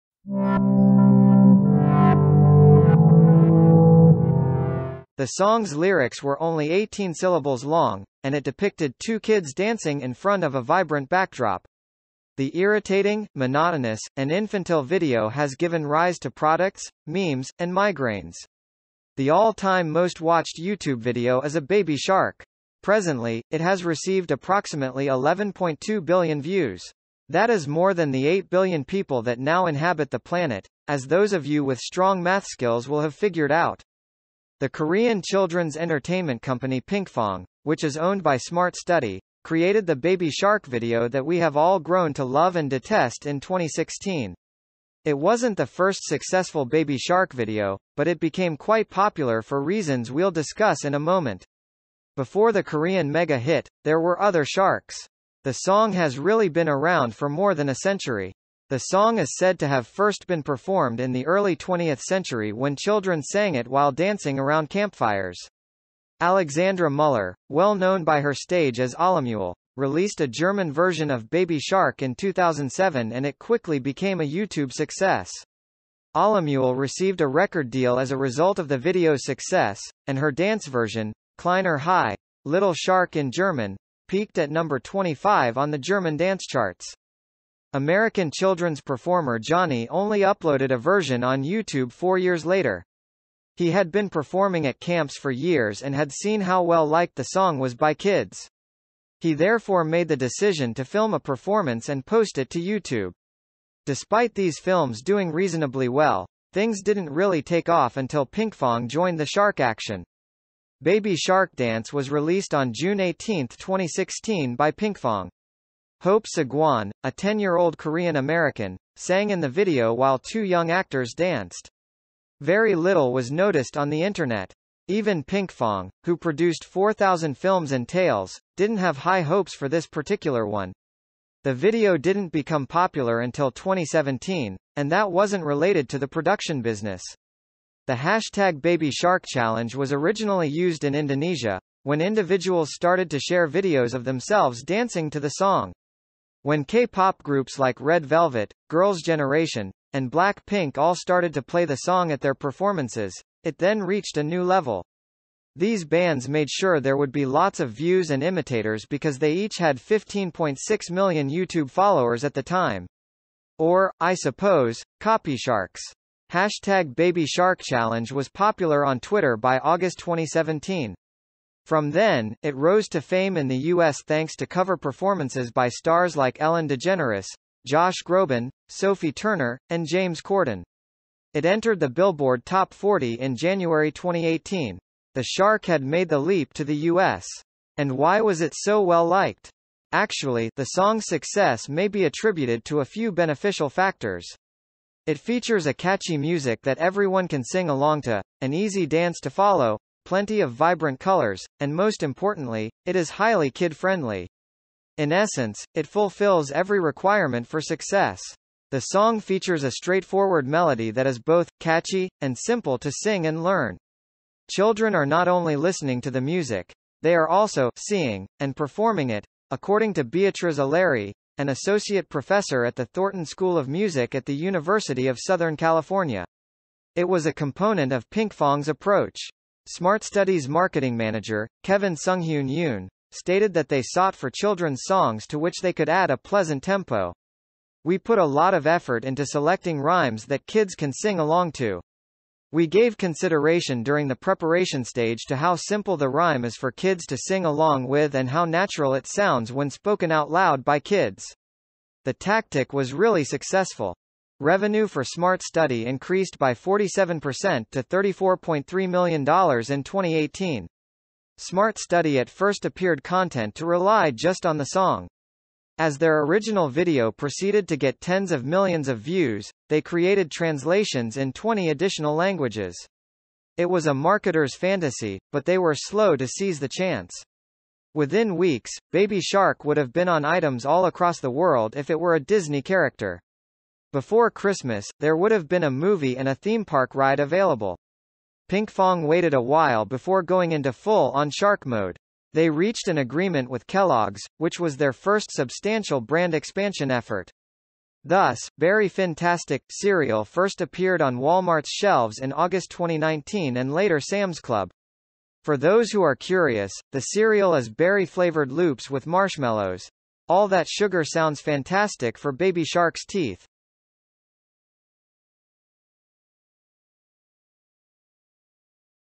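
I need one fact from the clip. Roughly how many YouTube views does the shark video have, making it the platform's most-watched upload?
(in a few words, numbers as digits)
11.2 billion.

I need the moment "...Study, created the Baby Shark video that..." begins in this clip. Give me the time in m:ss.
0:38.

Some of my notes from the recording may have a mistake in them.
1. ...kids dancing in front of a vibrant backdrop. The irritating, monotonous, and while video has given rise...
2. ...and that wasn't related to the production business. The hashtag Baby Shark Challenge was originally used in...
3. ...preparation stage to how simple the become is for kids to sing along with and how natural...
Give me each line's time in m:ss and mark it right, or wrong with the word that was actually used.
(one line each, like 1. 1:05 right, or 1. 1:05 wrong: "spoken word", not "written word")
1. 0:09 wrong: "infantile", not "while"
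2. 2:14 right
3. 4:04 wrong: "rhyme", not "become".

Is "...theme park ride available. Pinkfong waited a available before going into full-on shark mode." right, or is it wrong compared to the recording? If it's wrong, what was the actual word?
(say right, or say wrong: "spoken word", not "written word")
wrong: "while", not "available".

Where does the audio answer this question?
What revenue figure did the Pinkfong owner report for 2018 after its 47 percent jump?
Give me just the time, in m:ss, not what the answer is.
4:17.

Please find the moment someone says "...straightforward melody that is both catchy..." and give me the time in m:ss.
3:29.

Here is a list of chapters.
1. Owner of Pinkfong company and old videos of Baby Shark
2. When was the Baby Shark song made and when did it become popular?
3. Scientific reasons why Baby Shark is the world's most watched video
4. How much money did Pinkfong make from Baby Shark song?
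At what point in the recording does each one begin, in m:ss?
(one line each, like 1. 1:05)
1. 0:34
2. 1:48
3. 3:10
4. 4:14.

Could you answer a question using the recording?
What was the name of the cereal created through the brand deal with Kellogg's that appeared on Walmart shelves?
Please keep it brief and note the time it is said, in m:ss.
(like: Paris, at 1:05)
Berry Fantastic, at 4:58.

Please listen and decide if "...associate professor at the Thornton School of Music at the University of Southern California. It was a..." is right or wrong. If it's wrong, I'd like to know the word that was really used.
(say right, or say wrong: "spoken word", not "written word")
right.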